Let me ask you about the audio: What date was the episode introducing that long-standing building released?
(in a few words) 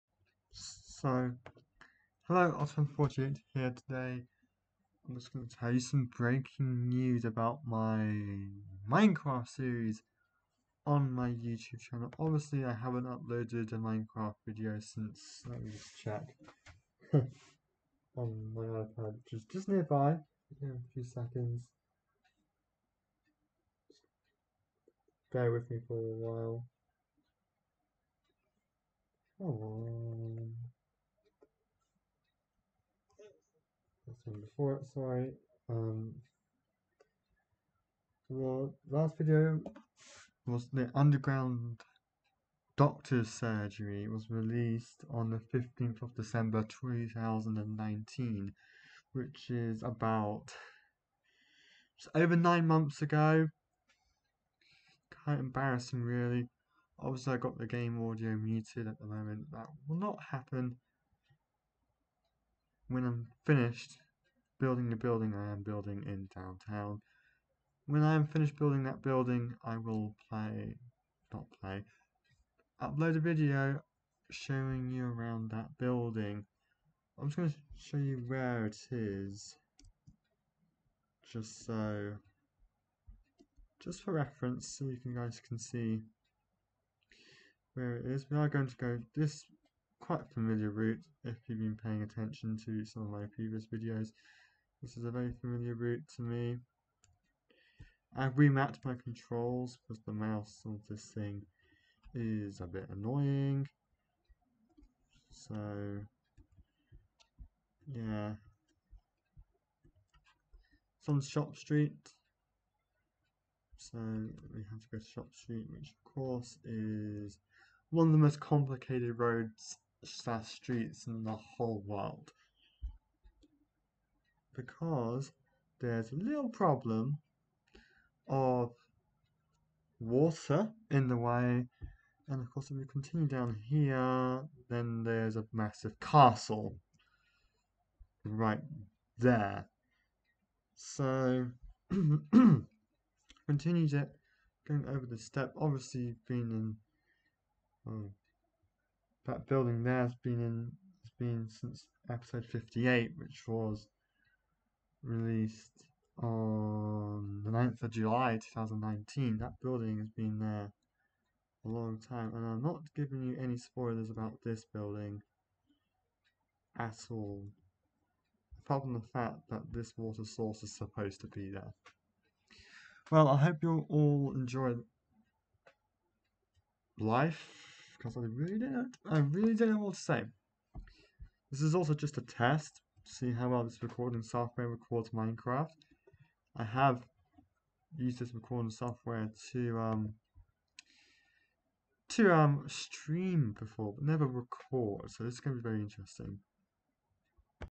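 9 July 2019.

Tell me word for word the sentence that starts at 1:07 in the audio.
When I am finished building that building, I will play, not play, upload a video showing you around that building.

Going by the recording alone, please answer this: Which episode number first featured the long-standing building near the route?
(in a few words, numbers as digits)
58.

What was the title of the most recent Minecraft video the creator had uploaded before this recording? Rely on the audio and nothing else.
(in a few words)
Underground Doctor's Surgery.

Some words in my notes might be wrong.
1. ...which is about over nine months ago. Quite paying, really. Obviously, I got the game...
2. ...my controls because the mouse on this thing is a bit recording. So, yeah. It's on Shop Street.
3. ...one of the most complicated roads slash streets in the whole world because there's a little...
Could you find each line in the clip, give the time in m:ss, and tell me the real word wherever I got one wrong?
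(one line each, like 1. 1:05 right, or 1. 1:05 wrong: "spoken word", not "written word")
1. 0:49 wrong: "embarrassing", not "paying"
2. 1:38 wrong: "annoying", not "recording"
3. 1:57 right.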